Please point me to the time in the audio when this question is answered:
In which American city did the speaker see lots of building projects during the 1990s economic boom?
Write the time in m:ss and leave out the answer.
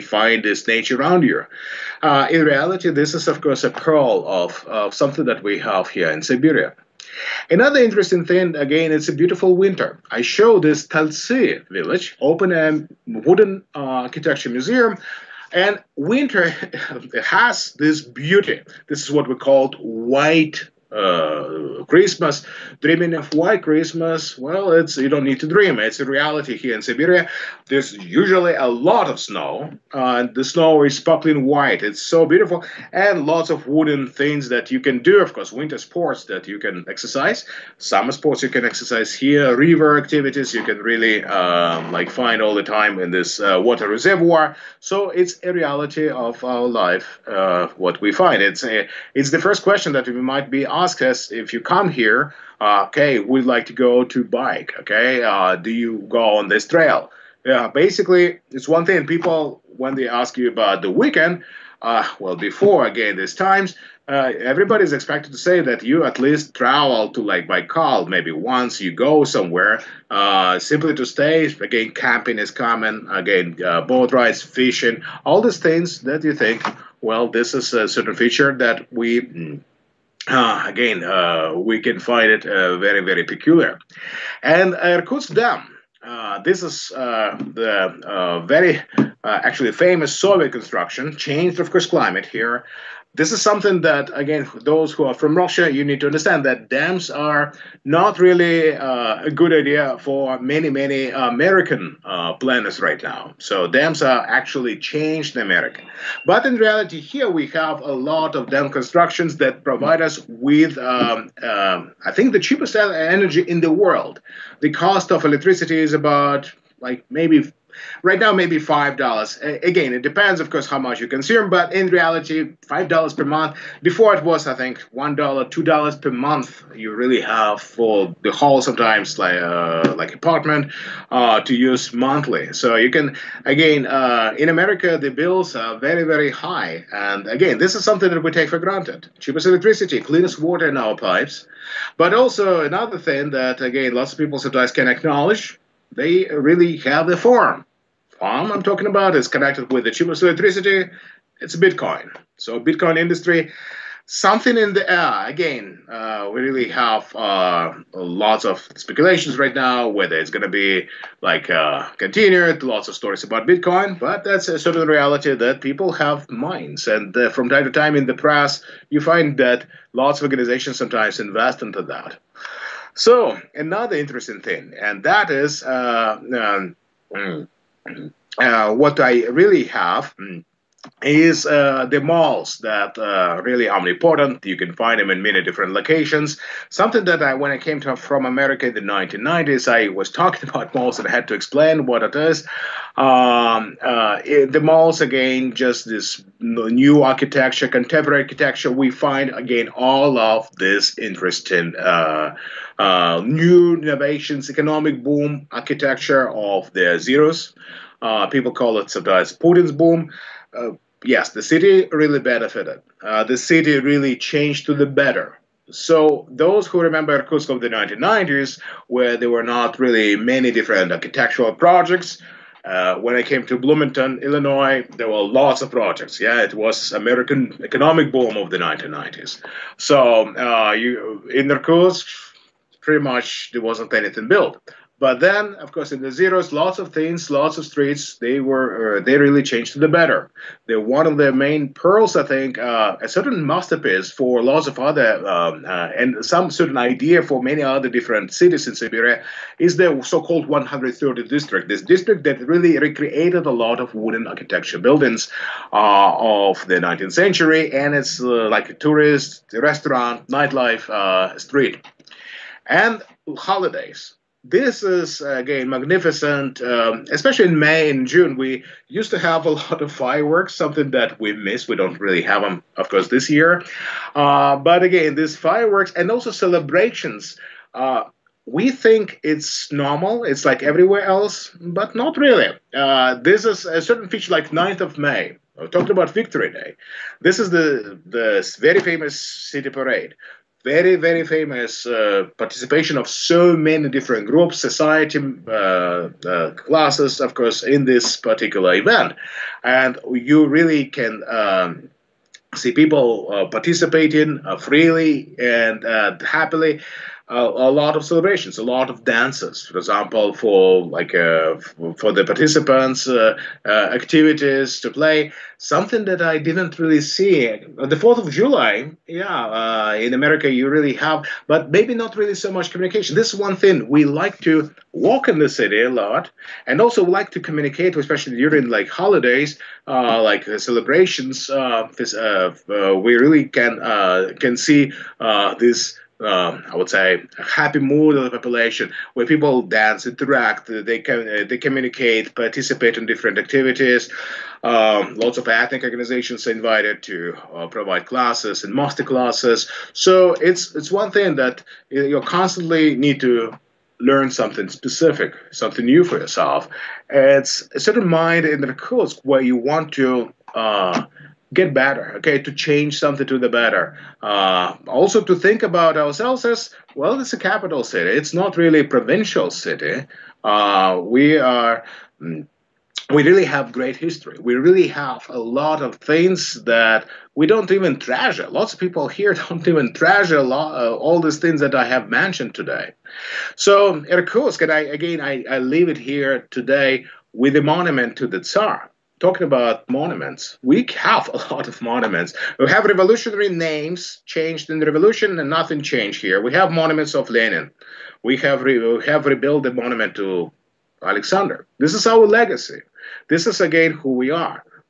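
3:43.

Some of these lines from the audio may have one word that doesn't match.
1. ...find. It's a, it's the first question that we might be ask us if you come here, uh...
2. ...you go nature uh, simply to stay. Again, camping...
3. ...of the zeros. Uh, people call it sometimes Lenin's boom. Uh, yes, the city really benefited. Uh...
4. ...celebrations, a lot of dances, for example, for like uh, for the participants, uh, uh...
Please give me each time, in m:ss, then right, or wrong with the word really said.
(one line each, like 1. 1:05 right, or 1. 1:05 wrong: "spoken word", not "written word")
1. 0:48 right
2. 1:08 wrong: "somewhere", not "nature"
3. 3:26 wrong: "Putin", not "Lenin"
4. 5:08 right.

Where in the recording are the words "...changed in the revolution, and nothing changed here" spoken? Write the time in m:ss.
6:34.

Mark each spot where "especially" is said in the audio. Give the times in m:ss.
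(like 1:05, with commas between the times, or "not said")
4:27, 5:27.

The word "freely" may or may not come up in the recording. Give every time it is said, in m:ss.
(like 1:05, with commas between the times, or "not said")
5:04.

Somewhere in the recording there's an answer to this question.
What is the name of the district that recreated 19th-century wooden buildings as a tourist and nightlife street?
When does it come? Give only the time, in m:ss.
4:10.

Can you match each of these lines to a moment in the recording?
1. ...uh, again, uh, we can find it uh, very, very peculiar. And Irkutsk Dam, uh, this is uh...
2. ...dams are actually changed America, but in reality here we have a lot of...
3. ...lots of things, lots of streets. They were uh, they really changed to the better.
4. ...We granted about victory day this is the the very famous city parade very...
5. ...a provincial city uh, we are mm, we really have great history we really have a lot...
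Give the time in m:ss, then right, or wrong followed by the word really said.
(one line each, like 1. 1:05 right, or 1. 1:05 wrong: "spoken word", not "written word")
1. 1:20 right
2. 1:43 right
3. 3:56 right
4. 4:45 wrong: "talked", not "granted"
5. 6:08 right.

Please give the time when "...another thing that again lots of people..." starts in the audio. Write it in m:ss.
2:22.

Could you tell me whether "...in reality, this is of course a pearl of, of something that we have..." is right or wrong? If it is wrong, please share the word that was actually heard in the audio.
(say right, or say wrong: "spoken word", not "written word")
right.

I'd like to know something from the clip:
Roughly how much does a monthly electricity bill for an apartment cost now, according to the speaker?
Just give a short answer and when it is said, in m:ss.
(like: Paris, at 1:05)
5 dollars, at 2:02.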